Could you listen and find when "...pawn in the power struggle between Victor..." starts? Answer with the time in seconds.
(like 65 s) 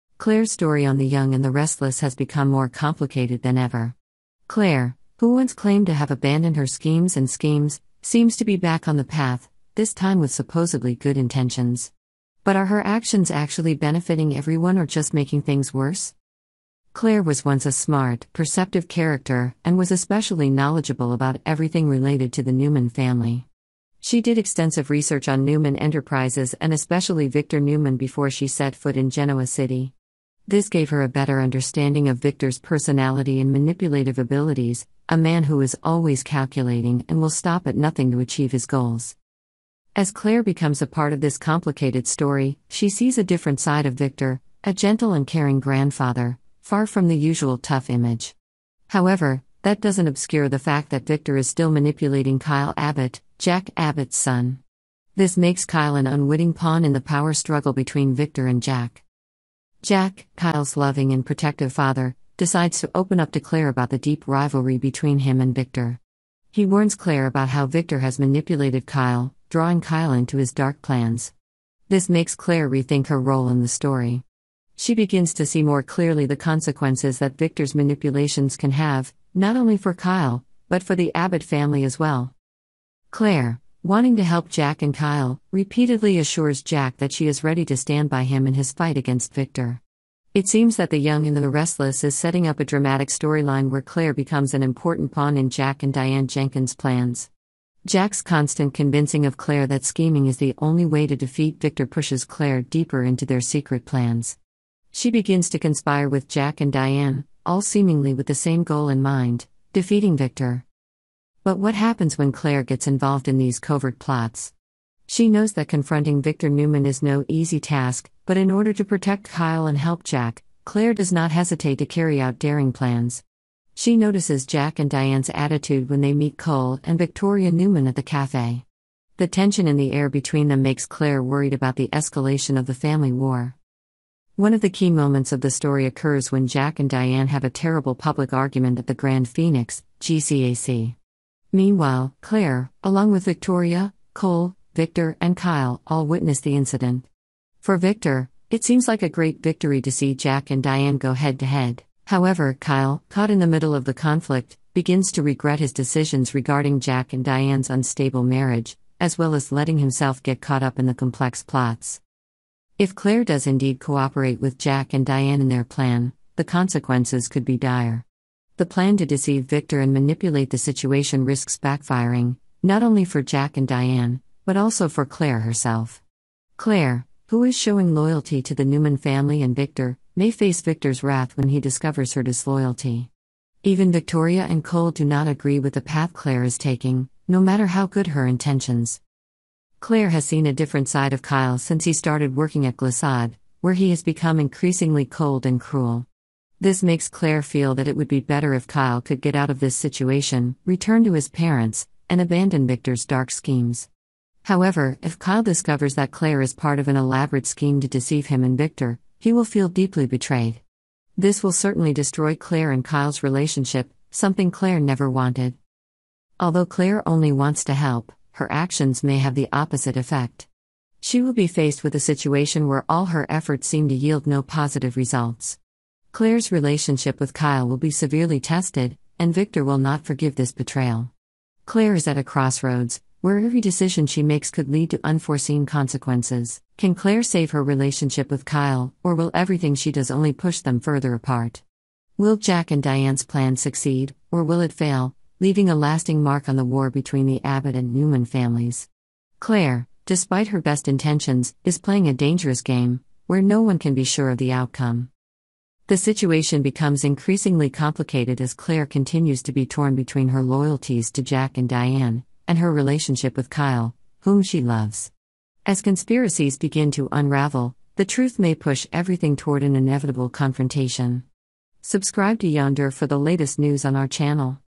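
56 s.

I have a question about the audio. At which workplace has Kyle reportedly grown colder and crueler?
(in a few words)
Glissade.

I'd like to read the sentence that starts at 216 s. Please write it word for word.
Although Claire only wants to help, her actions may have the opposite effect.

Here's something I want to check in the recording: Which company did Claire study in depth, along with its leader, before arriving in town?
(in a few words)
Newman Enterprises.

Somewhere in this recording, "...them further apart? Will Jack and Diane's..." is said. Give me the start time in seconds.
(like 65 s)
240 s.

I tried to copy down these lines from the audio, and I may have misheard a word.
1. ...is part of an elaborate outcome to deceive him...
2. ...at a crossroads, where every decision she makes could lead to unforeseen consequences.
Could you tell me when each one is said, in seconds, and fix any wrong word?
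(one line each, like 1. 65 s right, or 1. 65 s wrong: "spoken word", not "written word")
1. 206 s wrong: "scheme", not "outcome"
2. 232 s right.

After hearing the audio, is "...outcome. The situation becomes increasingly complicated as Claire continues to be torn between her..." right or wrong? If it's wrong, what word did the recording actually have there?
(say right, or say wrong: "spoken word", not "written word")
right.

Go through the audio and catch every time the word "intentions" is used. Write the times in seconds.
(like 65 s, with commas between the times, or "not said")
11 s, 188 s, 250 s.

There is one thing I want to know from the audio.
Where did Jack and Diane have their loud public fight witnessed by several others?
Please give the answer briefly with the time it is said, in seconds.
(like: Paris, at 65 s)
Grand Phoenix, at 138 s.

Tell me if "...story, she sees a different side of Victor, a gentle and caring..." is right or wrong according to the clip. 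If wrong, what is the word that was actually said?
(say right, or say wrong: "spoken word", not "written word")
right.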